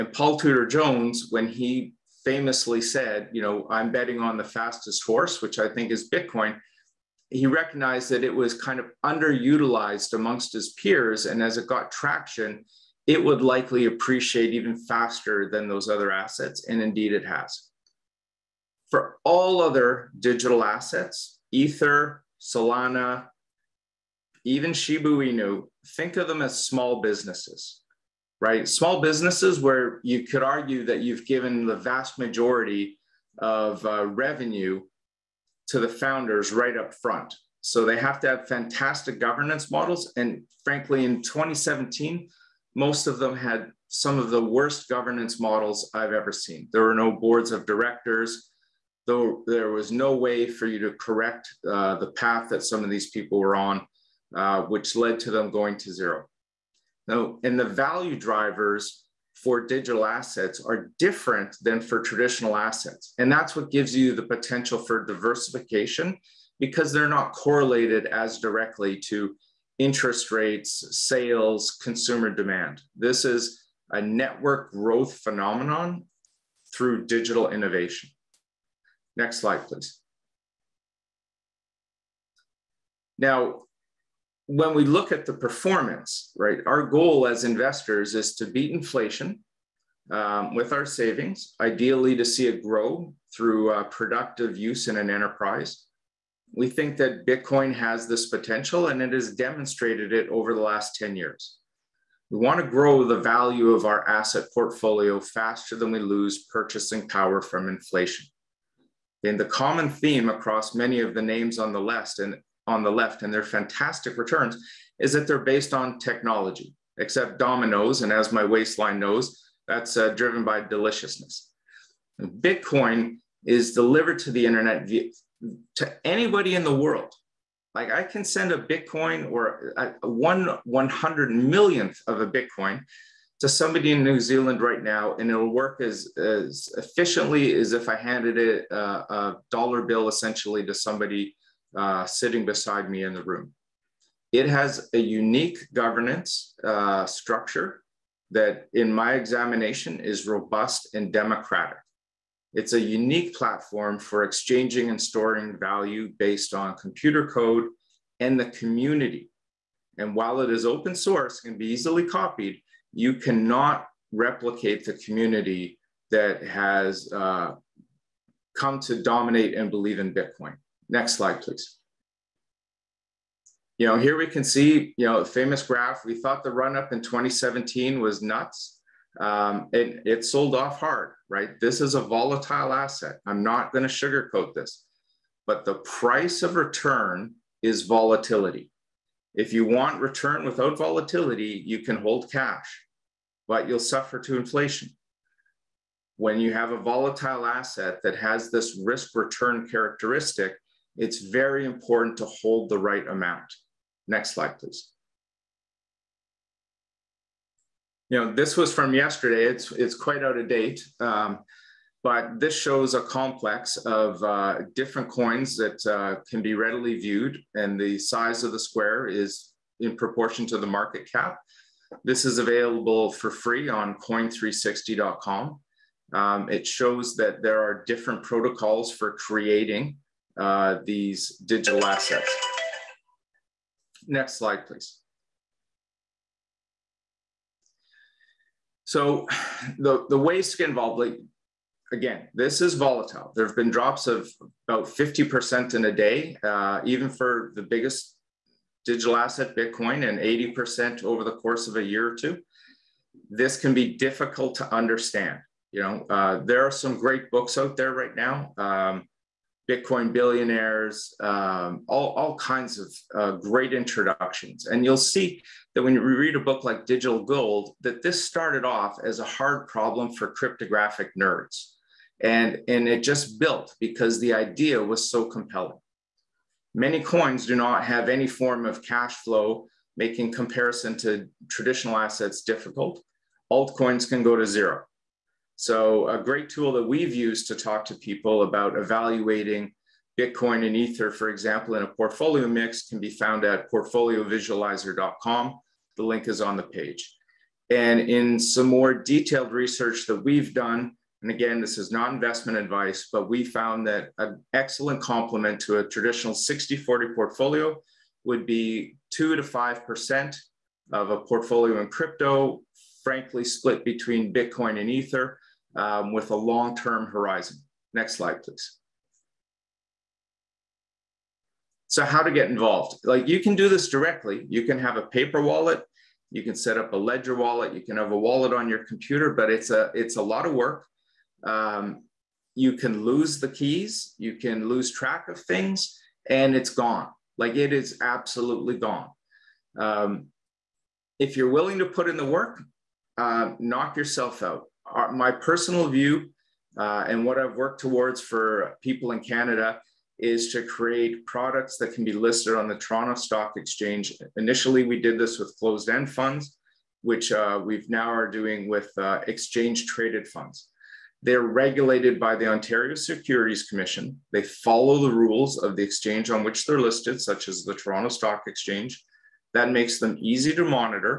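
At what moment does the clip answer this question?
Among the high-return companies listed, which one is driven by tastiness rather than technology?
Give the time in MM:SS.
01:57.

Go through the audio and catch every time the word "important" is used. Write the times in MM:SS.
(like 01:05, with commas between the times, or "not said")
03:21.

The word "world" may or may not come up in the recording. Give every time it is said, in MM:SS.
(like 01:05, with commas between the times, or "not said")
02:06.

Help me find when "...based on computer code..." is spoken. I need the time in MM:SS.
02:36.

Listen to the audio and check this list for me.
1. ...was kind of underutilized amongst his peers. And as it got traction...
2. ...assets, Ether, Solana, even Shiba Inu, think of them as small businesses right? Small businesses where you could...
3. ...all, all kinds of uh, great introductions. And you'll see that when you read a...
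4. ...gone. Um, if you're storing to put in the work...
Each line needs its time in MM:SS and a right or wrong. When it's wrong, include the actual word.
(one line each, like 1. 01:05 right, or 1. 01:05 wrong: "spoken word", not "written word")
1. 00:08 right
2. 00:20 right
3. 04:21 right
4. 05:38 wrong: "willing", not "storing".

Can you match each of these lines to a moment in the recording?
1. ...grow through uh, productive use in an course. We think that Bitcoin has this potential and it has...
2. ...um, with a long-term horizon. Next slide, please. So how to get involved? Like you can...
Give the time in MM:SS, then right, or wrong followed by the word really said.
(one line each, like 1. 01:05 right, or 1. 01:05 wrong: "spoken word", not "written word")
1. 01:32 wrong: "enterprise", not "course"
2. 05:15 right.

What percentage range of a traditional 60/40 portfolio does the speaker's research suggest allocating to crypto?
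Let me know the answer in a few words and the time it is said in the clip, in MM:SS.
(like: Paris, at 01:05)
2 to 5%, at 05:09.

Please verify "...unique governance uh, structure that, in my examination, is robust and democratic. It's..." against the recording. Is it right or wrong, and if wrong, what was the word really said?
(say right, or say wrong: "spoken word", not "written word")
right.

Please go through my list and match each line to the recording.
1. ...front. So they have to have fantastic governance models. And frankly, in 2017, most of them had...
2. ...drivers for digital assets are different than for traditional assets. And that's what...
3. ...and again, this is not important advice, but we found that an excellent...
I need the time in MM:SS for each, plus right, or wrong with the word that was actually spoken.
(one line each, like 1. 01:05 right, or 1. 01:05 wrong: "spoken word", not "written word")
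1. 00:36 right
2. 00:58 right
3. 05:01 wrong: "investment", not "important".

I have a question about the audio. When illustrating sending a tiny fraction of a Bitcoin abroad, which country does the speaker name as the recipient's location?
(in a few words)
New Zealand.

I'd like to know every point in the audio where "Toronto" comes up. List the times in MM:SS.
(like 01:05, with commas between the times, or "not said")
05:52, 06:07.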